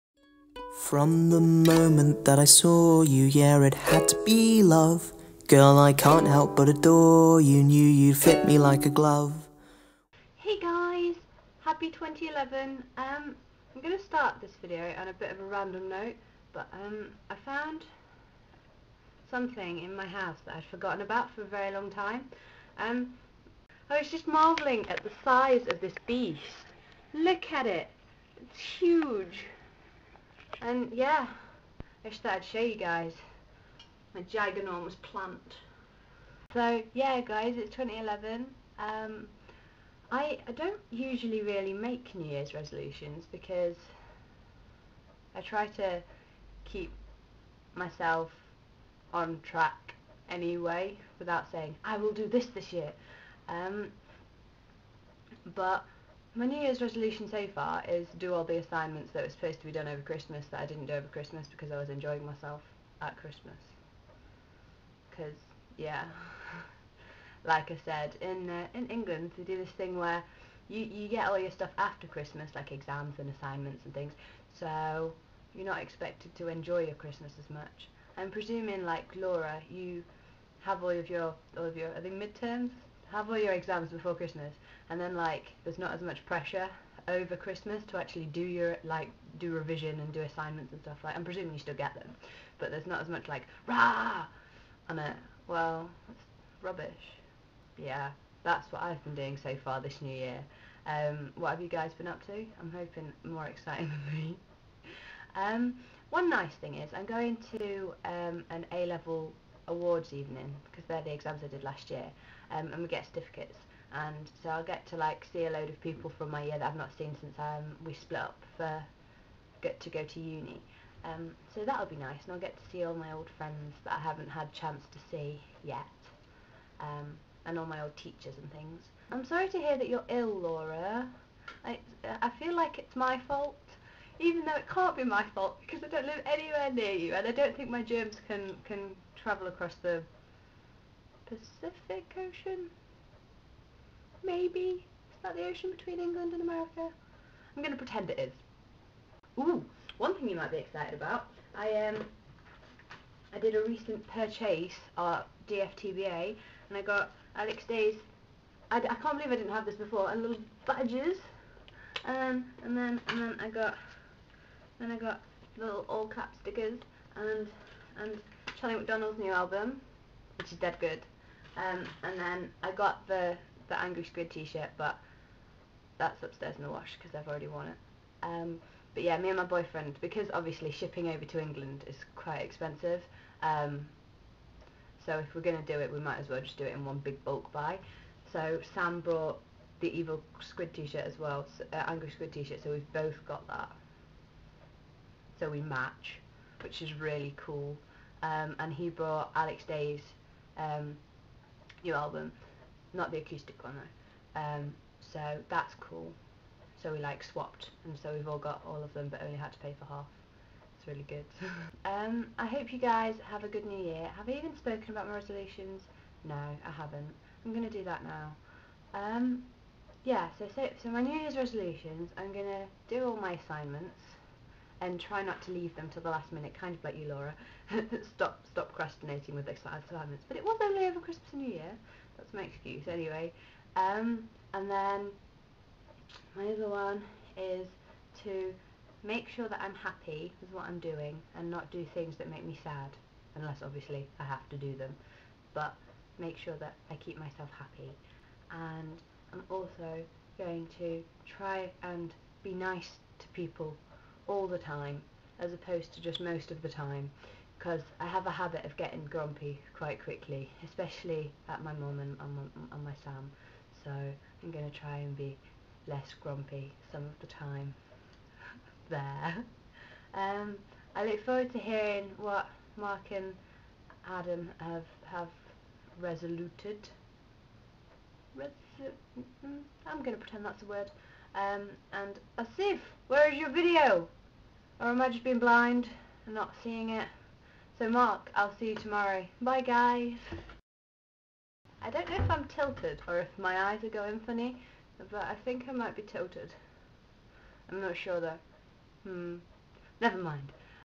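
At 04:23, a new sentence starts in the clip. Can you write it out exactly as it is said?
So I'm going to try and be less grumpy some of the time.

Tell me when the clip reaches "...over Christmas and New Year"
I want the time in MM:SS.
03:50.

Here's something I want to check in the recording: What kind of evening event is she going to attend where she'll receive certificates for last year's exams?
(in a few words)
A-level awards evening.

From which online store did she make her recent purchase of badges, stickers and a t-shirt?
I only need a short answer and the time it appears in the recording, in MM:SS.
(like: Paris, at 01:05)
DFTBA, at 02:35.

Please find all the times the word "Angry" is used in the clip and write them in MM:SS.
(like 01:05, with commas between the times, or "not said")
02:53, 03:11.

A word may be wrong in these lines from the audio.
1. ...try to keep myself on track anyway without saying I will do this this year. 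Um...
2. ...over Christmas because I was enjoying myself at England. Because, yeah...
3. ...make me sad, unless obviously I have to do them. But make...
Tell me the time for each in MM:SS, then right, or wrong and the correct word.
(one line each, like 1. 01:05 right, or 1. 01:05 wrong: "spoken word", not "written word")
1. 00:45 right
2. 01:00 wrong: "Christmas", not "England"
3. 04:02 right.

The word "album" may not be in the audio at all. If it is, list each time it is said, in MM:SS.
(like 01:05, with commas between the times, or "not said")
02:49, 03:21.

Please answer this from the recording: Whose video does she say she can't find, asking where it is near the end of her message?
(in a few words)
Asif.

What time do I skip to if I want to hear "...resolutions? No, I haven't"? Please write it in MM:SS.
03:35.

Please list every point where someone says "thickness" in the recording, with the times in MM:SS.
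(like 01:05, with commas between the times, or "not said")
not said.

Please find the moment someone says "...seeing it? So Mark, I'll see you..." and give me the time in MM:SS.
04:46.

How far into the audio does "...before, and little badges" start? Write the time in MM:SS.
02:39.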